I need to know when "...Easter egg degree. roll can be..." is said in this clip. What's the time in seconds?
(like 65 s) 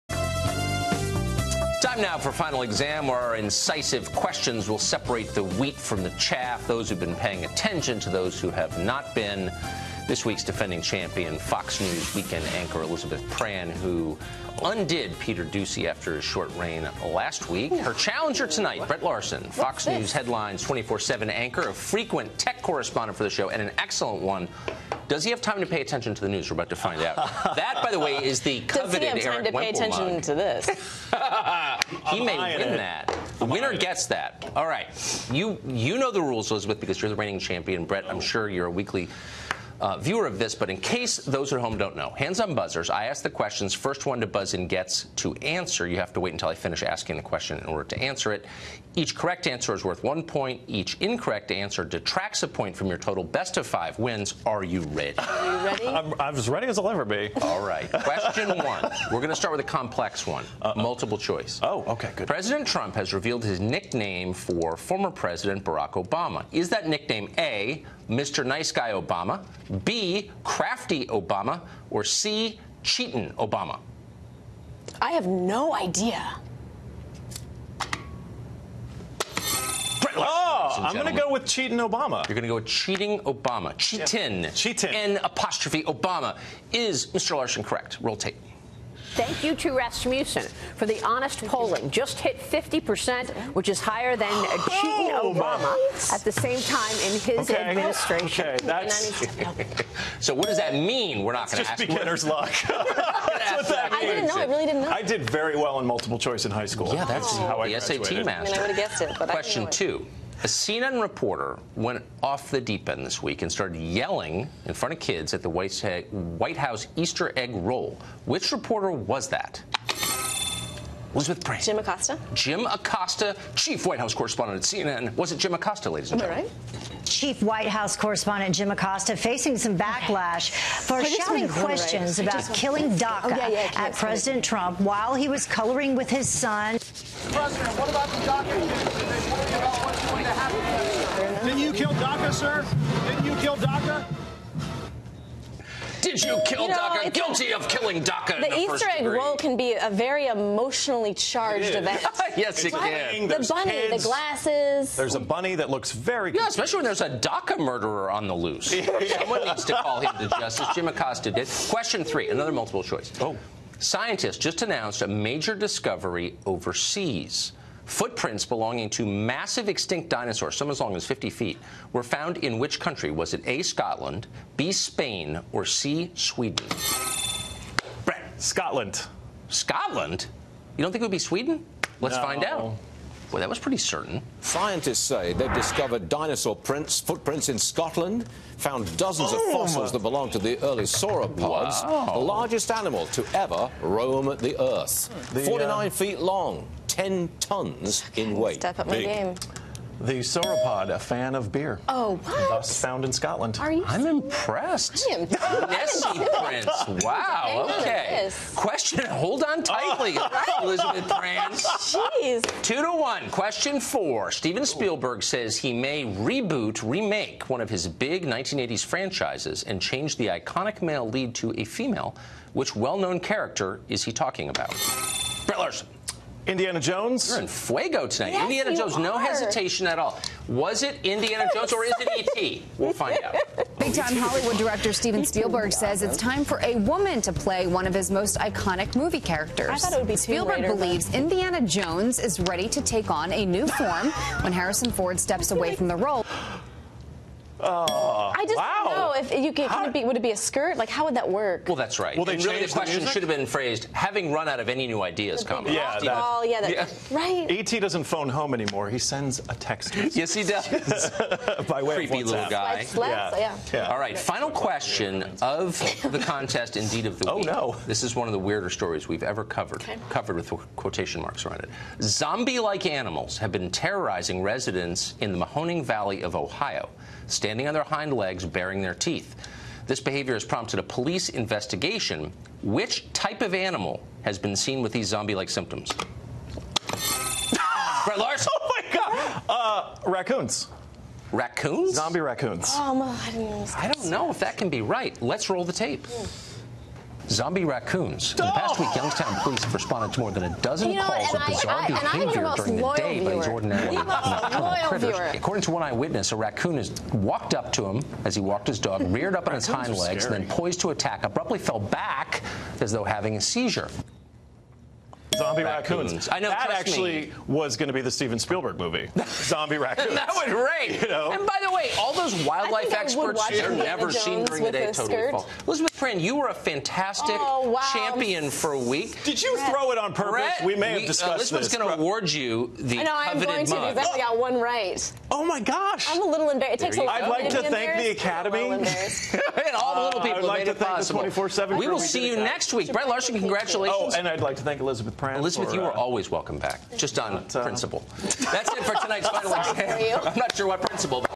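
148 s.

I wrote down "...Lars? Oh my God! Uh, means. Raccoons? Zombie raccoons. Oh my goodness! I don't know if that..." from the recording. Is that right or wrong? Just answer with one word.
wrong.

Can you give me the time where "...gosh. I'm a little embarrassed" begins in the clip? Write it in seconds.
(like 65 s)
335 s.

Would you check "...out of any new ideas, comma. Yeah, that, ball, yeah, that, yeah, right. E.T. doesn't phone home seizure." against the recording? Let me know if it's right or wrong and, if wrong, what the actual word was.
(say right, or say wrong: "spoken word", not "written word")
wrong: "anymore", not "seizure".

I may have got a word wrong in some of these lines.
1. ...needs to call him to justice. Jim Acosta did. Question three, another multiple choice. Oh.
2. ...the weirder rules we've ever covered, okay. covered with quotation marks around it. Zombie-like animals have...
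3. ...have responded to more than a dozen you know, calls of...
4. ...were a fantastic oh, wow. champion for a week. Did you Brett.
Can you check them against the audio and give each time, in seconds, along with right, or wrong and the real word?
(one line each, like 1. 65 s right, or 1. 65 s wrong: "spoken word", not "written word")
1. 159 s right
2. 268 s wrong: "stories", not "rules"
3. 299 s right
4. 326 s right.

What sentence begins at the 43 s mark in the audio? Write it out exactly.
First one to buzz in gets to answer.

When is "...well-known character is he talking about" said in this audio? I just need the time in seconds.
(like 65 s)
222 s.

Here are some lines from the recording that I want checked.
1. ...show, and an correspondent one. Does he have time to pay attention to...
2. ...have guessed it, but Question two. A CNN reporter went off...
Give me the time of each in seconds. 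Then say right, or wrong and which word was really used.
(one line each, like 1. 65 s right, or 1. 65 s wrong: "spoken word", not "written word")
1. 23 s wrong: "excellent", not "correspondent"
2. 108 s right.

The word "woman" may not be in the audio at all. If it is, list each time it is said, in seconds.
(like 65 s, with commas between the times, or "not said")
236 s.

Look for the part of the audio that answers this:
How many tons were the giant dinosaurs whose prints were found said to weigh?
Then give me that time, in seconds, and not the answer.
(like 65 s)
196 s.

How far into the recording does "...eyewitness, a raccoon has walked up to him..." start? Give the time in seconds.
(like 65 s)
305 s.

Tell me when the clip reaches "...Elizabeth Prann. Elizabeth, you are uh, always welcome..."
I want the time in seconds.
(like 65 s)
344 s.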